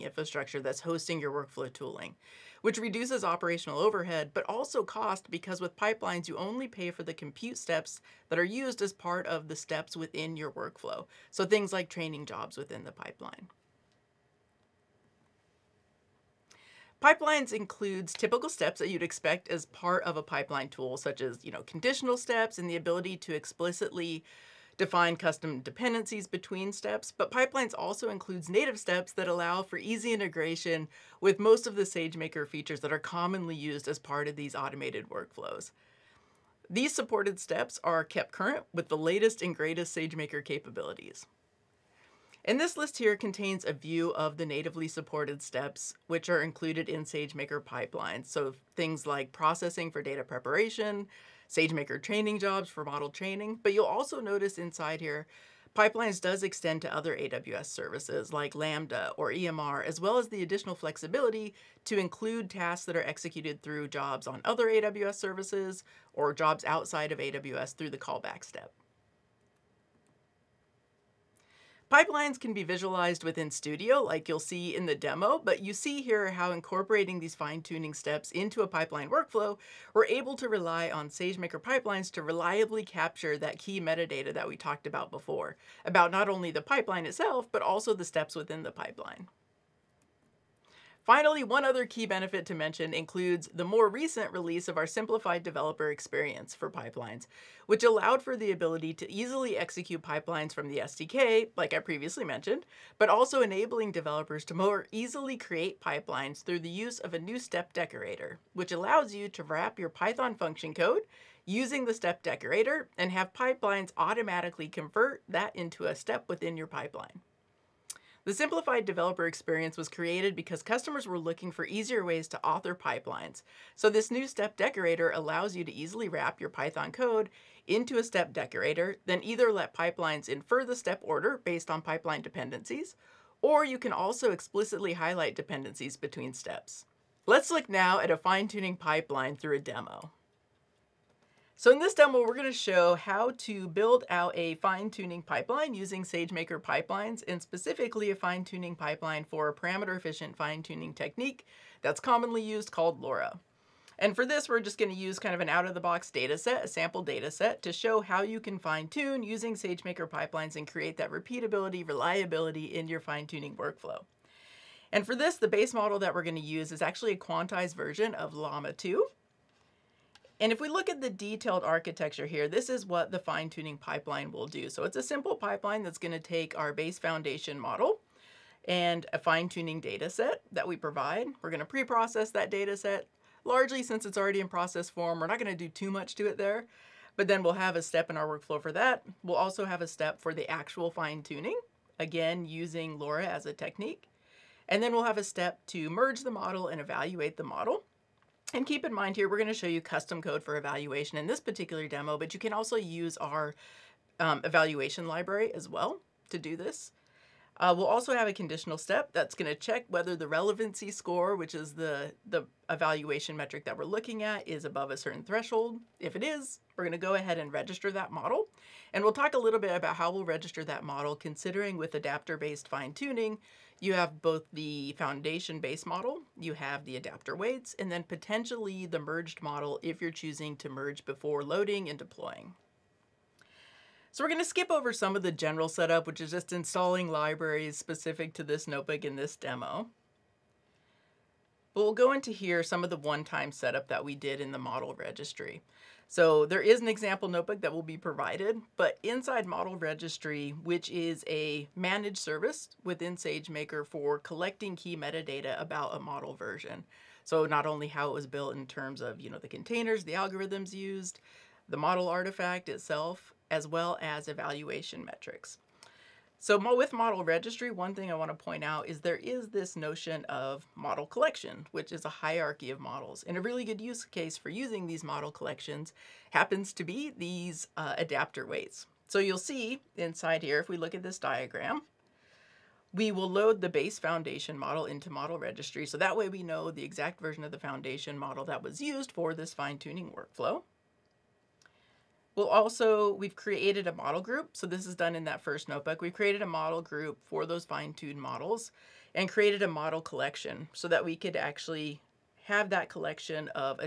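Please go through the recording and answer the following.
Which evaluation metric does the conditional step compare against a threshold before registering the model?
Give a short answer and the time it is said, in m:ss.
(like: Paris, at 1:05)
relevancy score, at 3:30.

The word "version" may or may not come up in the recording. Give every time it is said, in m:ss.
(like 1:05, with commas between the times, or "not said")
2:47, 4:16, 4:47.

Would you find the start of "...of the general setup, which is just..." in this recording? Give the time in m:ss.
3:55.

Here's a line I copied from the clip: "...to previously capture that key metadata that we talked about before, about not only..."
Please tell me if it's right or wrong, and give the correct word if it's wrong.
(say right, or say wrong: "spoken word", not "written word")
wrong: "reliably", not "previously".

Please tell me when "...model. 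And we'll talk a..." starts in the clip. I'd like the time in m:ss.
3:38.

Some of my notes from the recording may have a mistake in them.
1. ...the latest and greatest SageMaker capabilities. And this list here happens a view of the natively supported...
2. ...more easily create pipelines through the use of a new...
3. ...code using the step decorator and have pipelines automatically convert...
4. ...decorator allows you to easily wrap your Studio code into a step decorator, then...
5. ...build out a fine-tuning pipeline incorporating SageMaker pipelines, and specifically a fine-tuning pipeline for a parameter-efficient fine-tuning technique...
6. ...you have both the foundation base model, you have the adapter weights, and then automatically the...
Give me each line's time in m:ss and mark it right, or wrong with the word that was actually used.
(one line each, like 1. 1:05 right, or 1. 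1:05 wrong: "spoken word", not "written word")
1. 0:38 wrong: "contains", not "happens"
2. 1:44 right
3. 1:50 right
4. 2:04 wrong: "Python", not "Studio"
5. 2:23 wrong: "using", not "incorporating"
6. 3:43 wrong: "potentially", not "automatically".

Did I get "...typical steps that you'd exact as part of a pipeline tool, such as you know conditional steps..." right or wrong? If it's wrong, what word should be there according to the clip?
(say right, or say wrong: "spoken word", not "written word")
wrong: "expect", not "exact".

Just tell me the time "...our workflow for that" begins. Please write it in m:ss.
3:08.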